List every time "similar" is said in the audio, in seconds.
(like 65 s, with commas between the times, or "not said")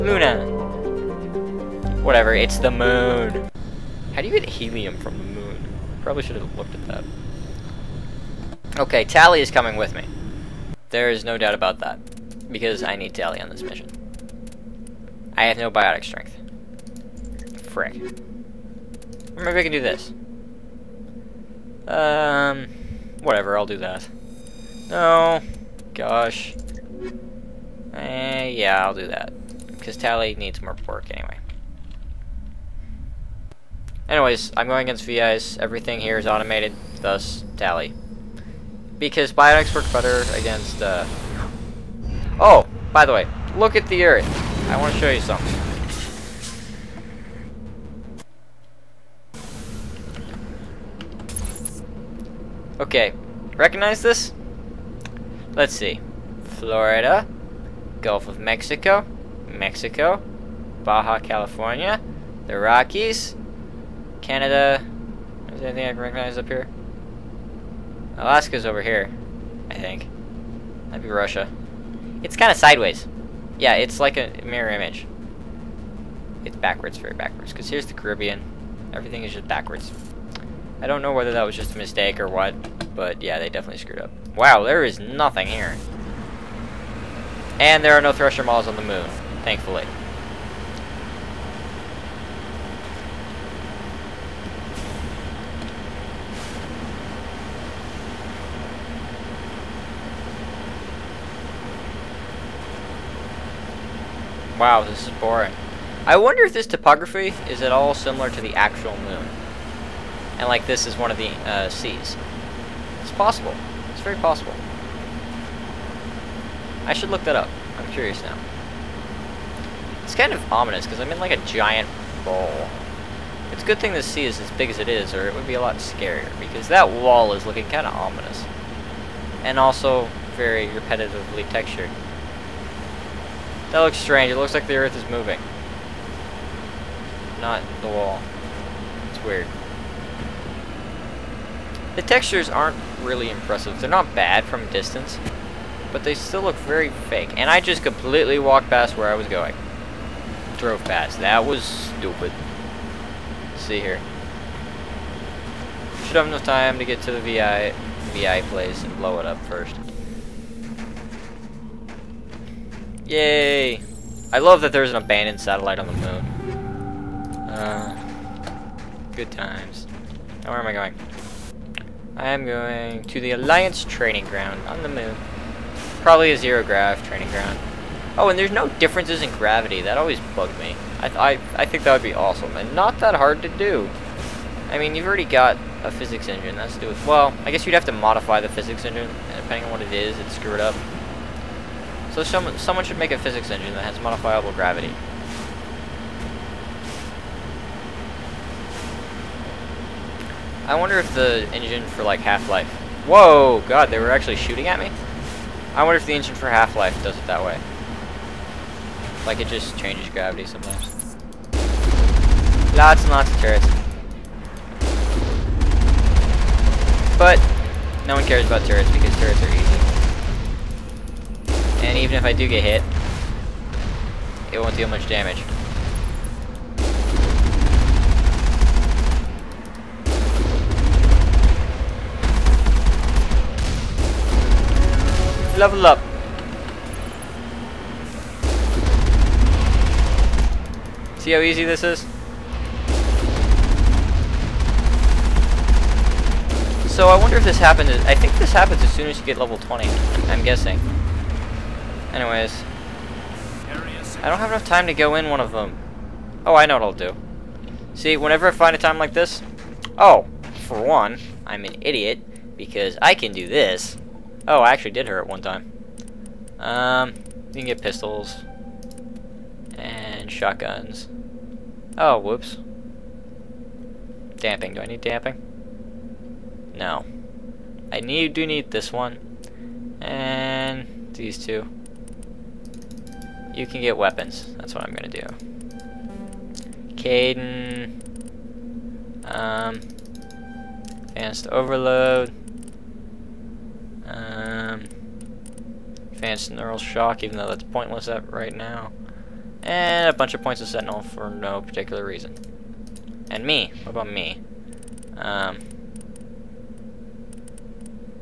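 107 s.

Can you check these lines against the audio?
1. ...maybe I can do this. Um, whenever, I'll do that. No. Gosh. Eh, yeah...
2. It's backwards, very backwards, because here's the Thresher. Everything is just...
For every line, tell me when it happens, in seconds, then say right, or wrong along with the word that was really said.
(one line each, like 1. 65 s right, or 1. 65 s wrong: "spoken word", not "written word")
1. 19 s wrong: "whatever", not "whenever"
2. 76 s wrong: "Caribbean", not "Thresher".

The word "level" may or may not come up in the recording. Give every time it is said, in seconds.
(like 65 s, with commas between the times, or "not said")
235 s, 249 s.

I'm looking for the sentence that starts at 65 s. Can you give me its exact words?
Is there anything I can recognize up here?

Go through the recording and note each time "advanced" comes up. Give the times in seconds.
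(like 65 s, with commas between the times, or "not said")
291 s, 296 s.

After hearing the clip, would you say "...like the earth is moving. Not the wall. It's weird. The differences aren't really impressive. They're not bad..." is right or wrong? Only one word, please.
wrong.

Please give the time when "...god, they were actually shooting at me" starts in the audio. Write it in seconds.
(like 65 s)
203 s.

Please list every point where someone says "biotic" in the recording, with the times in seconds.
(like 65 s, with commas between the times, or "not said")
15 s, 39 s.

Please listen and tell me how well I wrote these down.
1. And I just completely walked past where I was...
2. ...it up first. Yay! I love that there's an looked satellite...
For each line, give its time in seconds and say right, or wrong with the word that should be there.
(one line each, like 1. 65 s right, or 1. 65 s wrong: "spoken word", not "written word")
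1. 147 s right
2. 159 s wrong: "abandoned", not "looked".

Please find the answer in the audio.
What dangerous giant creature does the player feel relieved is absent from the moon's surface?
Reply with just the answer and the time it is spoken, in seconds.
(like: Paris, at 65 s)
Thresher Maws, at 88 s.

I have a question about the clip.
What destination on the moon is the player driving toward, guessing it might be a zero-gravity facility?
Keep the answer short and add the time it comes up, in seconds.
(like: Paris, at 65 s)
Alliance Training Ground, at 173 s.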